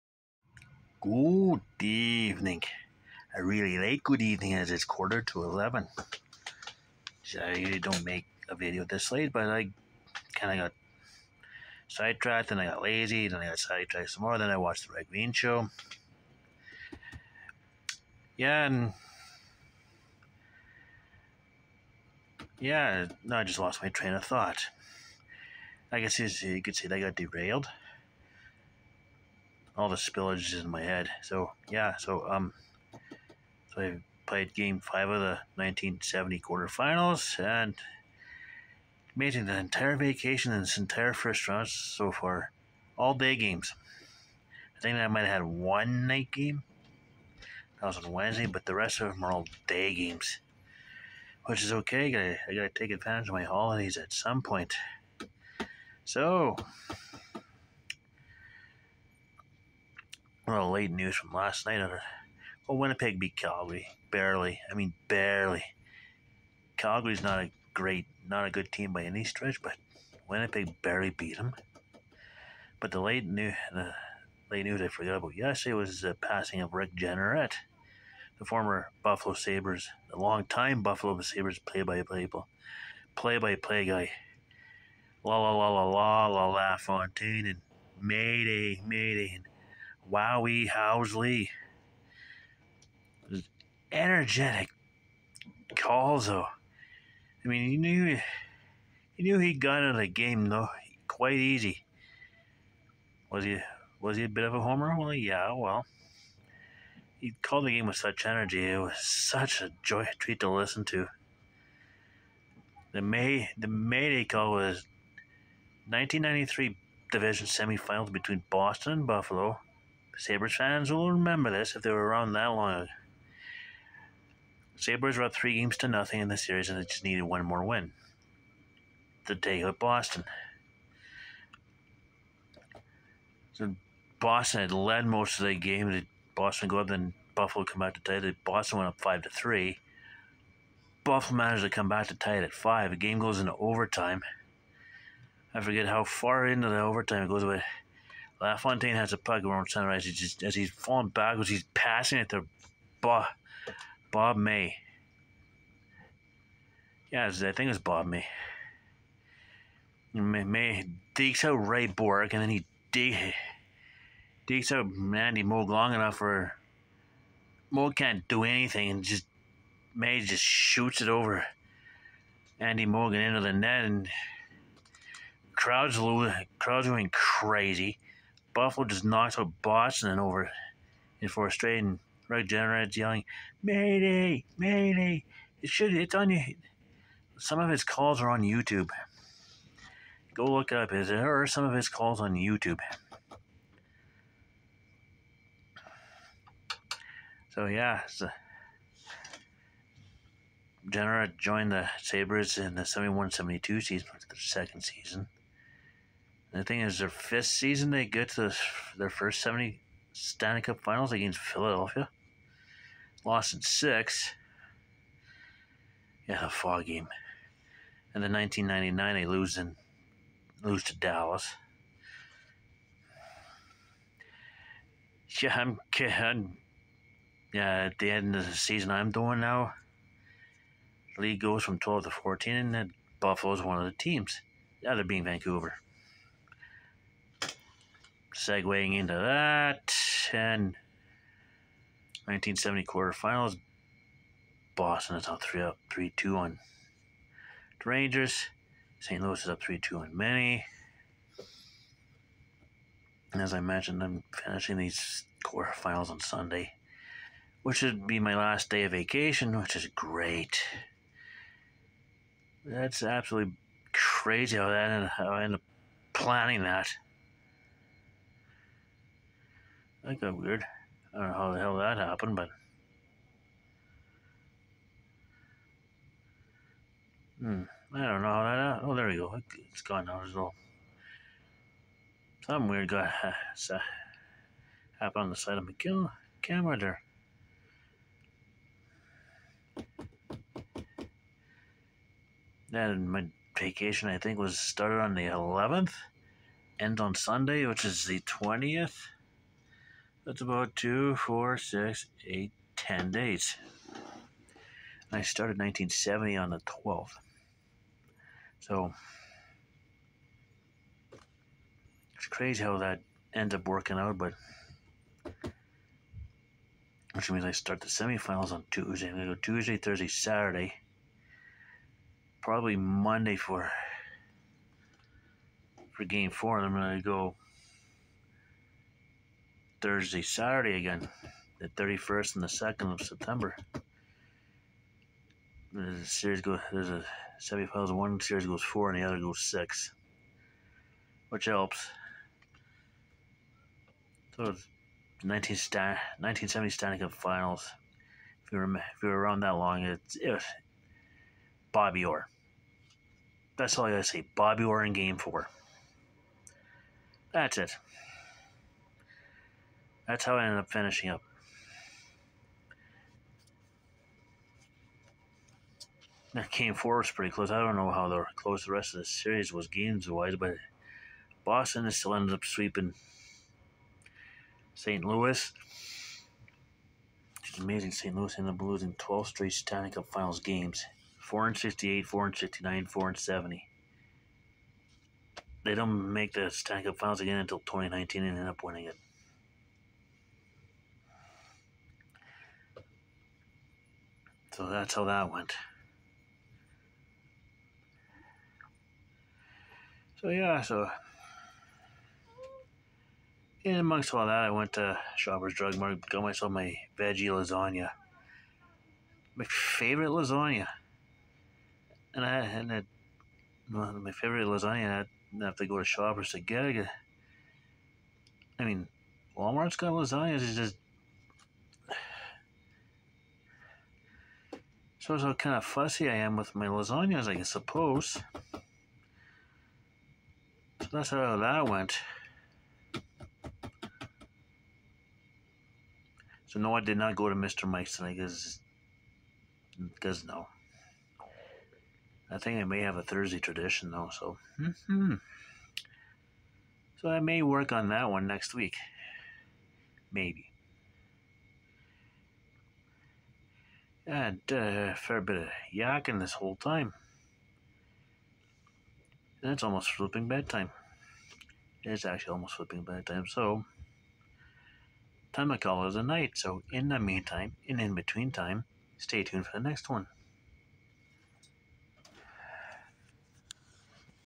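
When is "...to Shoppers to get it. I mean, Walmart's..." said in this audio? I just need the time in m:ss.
6:55.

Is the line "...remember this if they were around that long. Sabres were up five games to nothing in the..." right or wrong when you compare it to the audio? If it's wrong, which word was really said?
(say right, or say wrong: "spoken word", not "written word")
wrong: "three", not "five".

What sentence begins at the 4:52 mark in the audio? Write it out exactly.
my vacation, I think, was started on the 11th, end on Sunday, which is the 20th.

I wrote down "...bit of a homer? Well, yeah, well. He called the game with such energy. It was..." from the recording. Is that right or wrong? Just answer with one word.
right.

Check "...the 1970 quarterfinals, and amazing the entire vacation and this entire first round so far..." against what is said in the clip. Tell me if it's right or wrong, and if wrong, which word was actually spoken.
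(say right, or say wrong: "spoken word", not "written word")
right.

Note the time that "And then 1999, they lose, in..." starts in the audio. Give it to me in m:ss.
3:38.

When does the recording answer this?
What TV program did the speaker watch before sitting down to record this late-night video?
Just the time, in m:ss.
0:14.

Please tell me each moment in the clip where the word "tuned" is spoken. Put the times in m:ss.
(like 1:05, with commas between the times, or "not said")
7:49.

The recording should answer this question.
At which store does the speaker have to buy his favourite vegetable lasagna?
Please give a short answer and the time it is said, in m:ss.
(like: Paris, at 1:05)
Shoppers Drug Mart, at 6:45.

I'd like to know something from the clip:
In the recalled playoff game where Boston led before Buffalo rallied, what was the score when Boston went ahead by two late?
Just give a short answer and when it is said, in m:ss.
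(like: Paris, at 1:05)
5-3, at 2:19.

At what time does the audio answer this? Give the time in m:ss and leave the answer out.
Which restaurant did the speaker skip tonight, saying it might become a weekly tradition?
7:17.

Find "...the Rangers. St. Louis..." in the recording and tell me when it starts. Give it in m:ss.
4:07.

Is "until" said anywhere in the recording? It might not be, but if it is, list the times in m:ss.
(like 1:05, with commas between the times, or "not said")
6:27.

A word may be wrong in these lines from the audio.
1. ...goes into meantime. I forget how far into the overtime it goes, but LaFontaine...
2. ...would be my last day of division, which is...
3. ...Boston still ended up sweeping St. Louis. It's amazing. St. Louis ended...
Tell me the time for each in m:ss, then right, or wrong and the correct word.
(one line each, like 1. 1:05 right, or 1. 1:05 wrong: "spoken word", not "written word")
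1. 2:23 wrong: "overtime", not "meantime"
2. 4:17 wrong: "vacation", not "division"
3. 6:11 right.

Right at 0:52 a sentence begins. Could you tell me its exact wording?
I gotta, I gotta take advantage of my holidays at some point.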